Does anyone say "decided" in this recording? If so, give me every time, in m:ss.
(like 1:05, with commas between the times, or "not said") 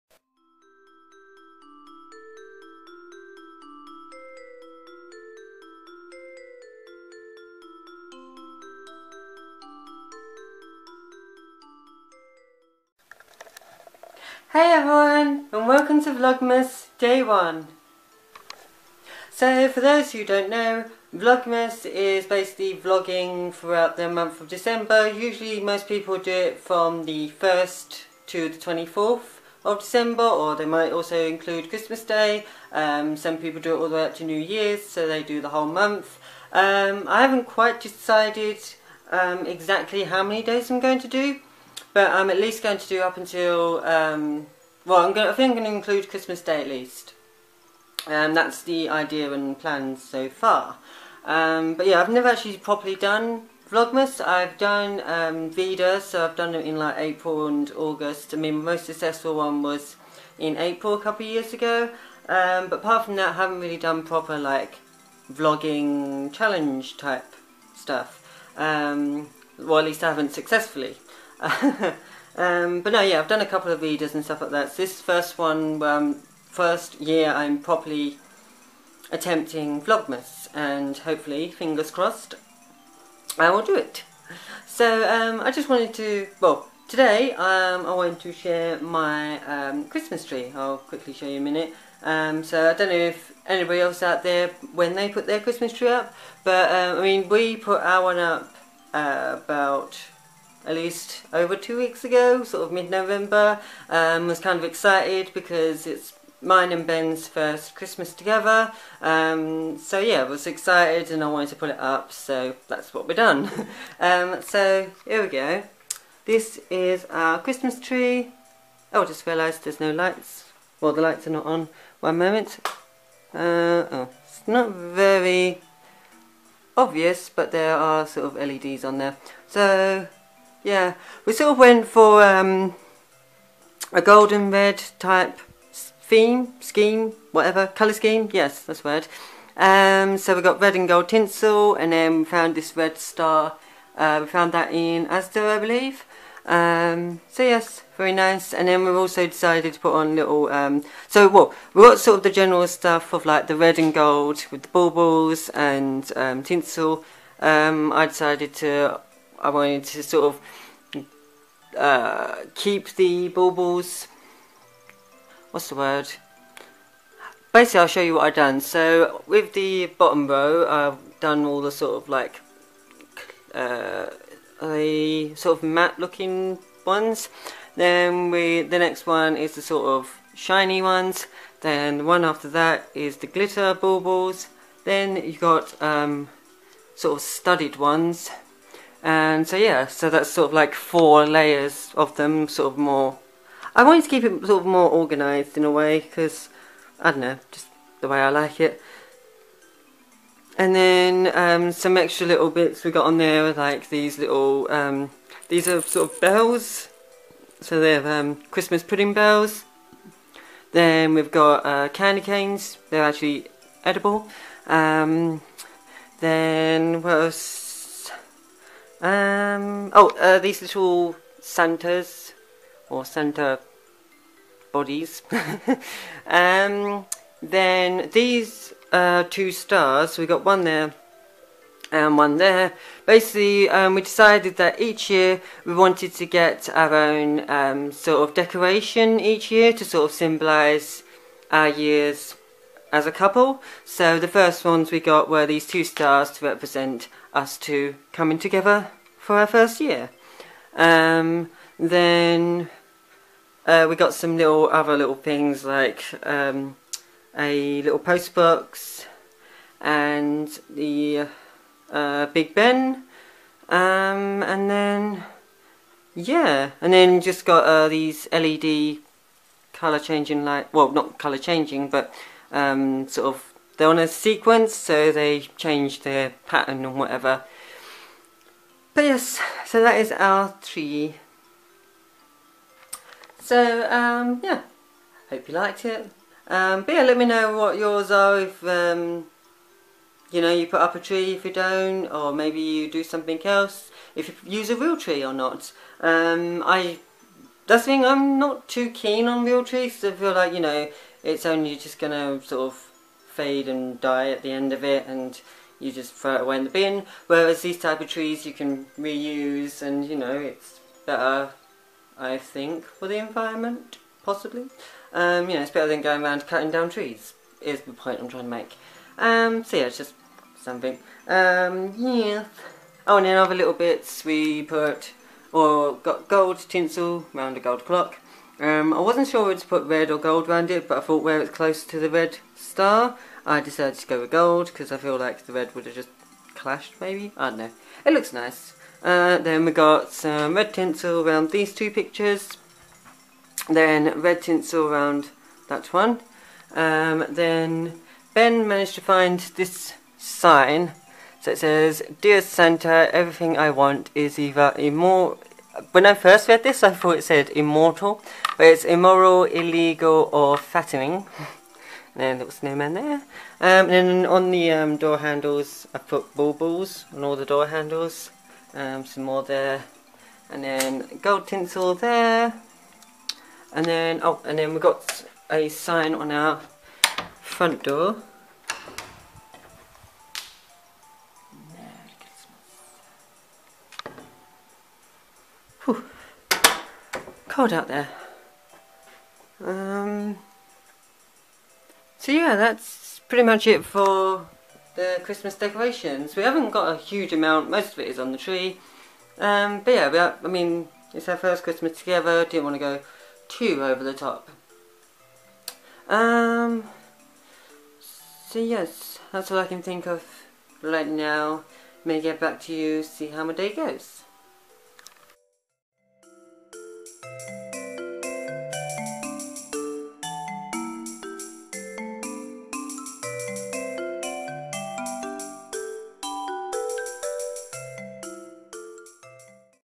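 0:37, 2:29, 2:38, 3:54, 5:33.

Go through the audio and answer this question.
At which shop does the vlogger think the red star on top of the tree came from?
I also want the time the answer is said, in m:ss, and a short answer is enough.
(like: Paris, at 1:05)
Asda, at 2:25.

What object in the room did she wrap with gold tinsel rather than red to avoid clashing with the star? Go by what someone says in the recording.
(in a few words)
A gold clock.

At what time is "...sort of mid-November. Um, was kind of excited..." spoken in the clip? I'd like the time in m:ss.
1:42.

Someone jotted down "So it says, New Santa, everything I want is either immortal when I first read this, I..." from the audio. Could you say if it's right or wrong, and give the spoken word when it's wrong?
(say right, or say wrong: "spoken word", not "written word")
wrong: "Dear", not "New".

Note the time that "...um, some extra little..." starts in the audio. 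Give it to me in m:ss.
3:21.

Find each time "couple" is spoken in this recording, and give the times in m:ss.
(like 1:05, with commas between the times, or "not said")
1:00, 1:13, 4:03.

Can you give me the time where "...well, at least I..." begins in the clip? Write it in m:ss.
1:09.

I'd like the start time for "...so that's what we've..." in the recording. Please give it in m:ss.
1:52.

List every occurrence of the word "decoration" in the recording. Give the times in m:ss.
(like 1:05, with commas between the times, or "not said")
3:58, 6:35.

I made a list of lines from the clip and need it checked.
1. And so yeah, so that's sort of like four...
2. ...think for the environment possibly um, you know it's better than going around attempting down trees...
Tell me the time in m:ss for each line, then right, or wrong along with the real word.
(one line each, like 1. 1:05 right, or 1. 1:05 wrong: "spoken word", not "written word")
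1. 3:09 right
2. 5:12 wrong: "cutting", not "attempting".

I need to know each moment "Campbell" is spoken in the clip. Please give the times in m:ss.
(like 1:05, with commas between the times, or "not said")
not said.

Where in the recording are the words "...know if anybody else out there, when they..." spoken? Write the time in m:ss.
1:32.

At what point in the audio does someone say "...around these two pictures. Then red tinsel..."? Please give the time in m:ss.
5:41.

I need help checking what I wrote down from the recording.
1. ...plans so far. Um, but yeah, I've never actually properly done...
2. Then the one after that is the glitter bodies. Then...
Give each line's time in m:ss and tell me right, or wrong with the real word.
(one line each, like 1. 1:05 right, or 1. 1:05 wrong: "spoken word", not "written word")
1. 0:49 right
2. 3:01 wrong: "baubles", not "bodies".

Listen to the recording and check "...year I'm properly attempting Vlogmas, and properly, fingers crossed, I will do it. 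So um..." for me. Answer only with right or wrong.
wrong.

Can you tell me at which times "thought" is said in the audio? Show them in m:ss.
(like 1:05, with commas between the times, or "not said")
5:31, 5:56.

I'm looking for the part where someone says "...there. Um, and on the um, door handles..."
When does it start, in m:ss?
6:02.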